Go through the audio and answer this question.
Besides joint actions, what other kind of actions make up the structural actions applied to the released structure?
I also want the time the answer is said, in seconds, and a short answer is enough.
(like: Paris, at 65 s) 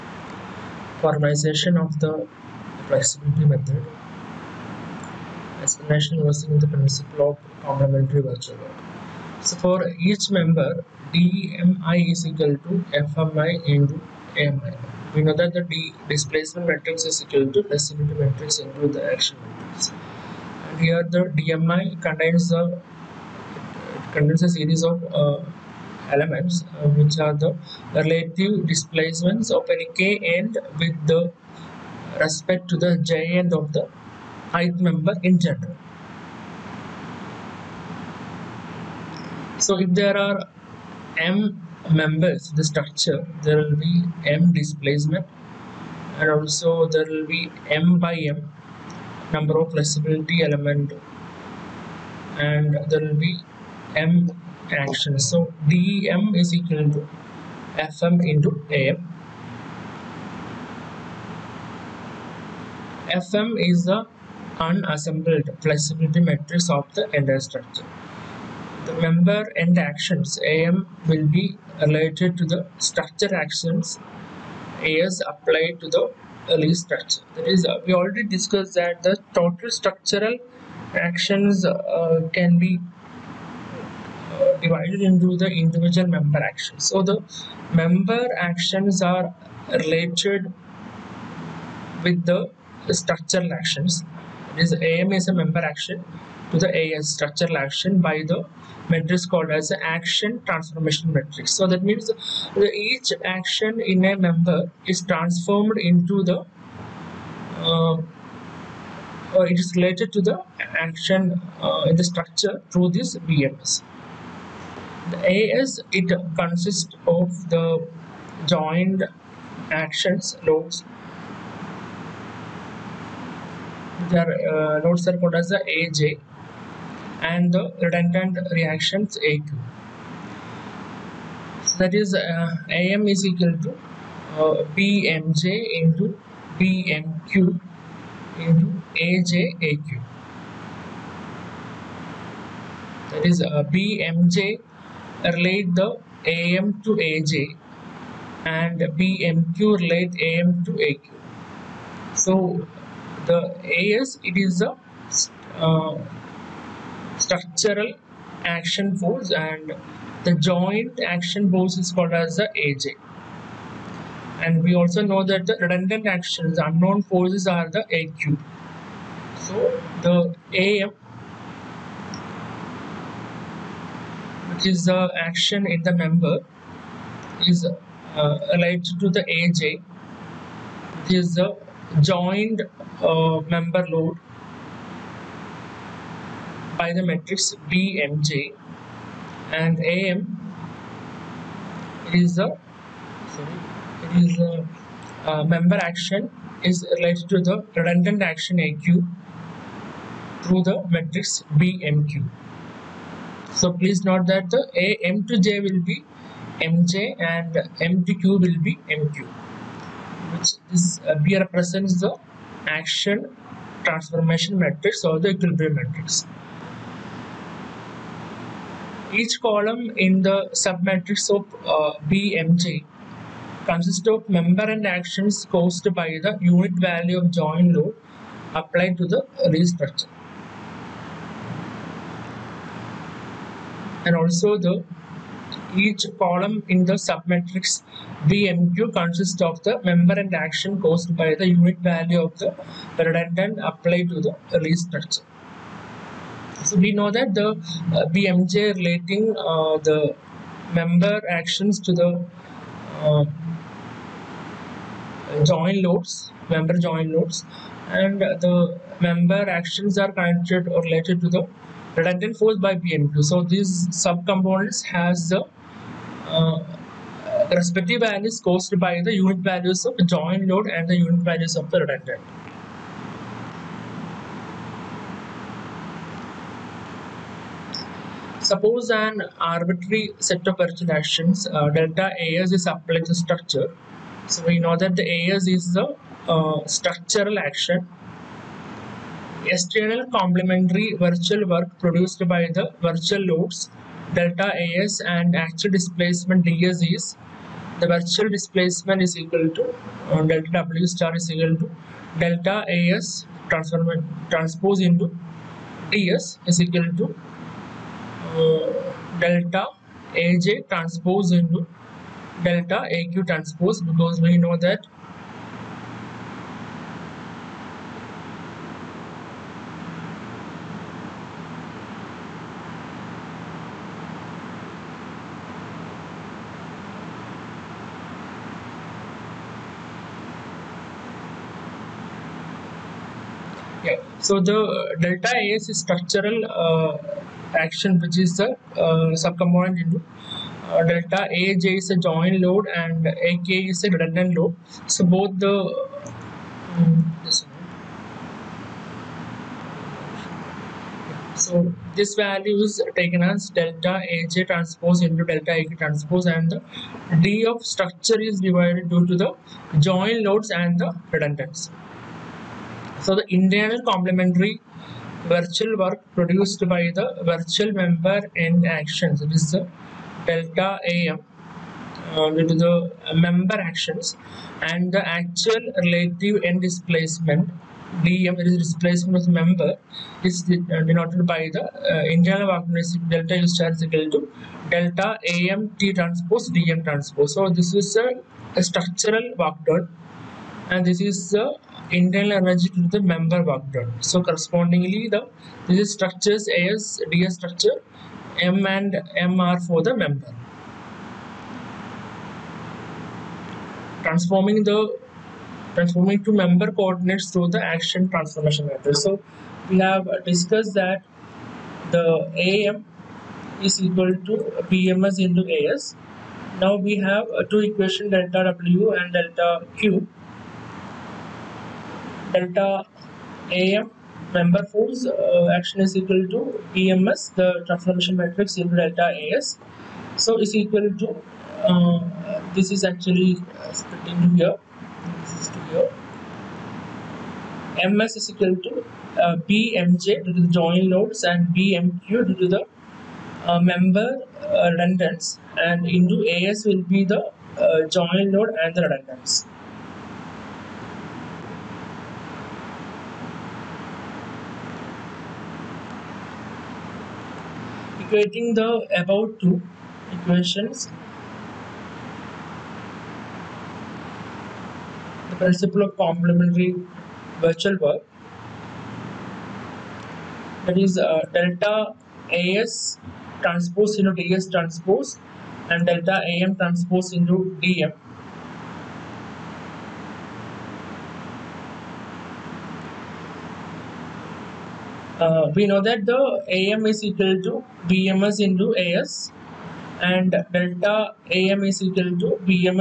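Redundant reactions, at 127 s.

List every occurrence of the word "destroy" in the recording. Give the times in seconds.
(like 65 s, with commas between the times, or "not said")
not said.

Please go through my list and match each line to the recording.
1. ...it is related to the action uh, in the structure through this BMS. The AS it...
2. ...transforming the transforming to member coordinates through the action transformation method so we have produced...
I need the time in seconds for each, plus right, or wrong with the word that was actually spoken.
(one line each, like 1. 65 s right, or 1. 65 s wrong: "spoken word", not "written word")
1. 109 s right
2. 404 s wrong: "discussed", not "produced".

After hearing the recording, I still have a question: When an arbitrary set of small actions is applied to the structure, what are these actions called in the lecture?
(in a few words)
Correction actions.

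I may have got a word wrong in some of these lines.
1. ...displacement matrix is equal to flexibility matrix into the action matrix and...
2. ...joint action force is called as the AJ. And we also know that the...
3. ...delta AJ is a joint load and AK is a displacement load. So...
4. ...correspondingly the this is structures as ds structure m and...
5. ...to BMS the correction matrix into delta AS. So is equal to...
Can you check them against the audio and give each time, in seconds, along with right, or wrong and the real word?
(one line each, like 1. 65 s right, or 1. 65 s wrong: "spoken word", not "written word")
1. 16 s right
2. 160 s right
3. 340 s wrong: "redundant", not "displacement"
4. 394 s right
5. 426 s wrong: "transformation", not "correction".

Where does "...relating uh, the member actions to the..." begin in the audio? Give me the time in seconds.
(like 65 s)
248 s.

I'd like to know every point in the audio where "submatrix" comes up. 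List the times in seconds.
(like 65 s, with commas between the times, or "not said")
220 s, 237 s.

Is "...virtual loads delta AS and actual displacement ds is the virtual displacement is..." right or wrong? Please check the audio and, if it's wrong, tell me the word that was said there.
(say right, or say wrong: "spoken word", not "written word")
right.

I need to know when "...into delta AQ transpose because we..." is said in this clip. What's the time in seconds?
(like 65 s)
311 s.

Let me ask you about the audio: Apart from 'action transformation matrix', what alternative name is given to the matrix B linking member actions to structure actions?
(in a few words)
Equilibrium matrix.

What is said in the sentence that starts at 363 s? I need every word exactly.
So the internal complementary virtual work produced by the virtual member in actions.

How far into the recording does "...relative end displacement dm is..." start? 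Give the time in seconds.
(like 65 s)
375 s.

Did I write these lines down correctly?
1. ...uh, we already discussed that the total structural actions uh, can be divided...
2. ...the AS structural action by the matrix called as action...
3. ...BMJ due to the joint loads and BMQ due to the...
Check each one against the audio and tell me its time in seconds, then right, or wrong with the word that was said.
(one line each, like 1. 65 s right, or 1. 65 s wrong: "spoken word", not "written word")
1. 77 s right
2. 96 s right
3. 439 s right.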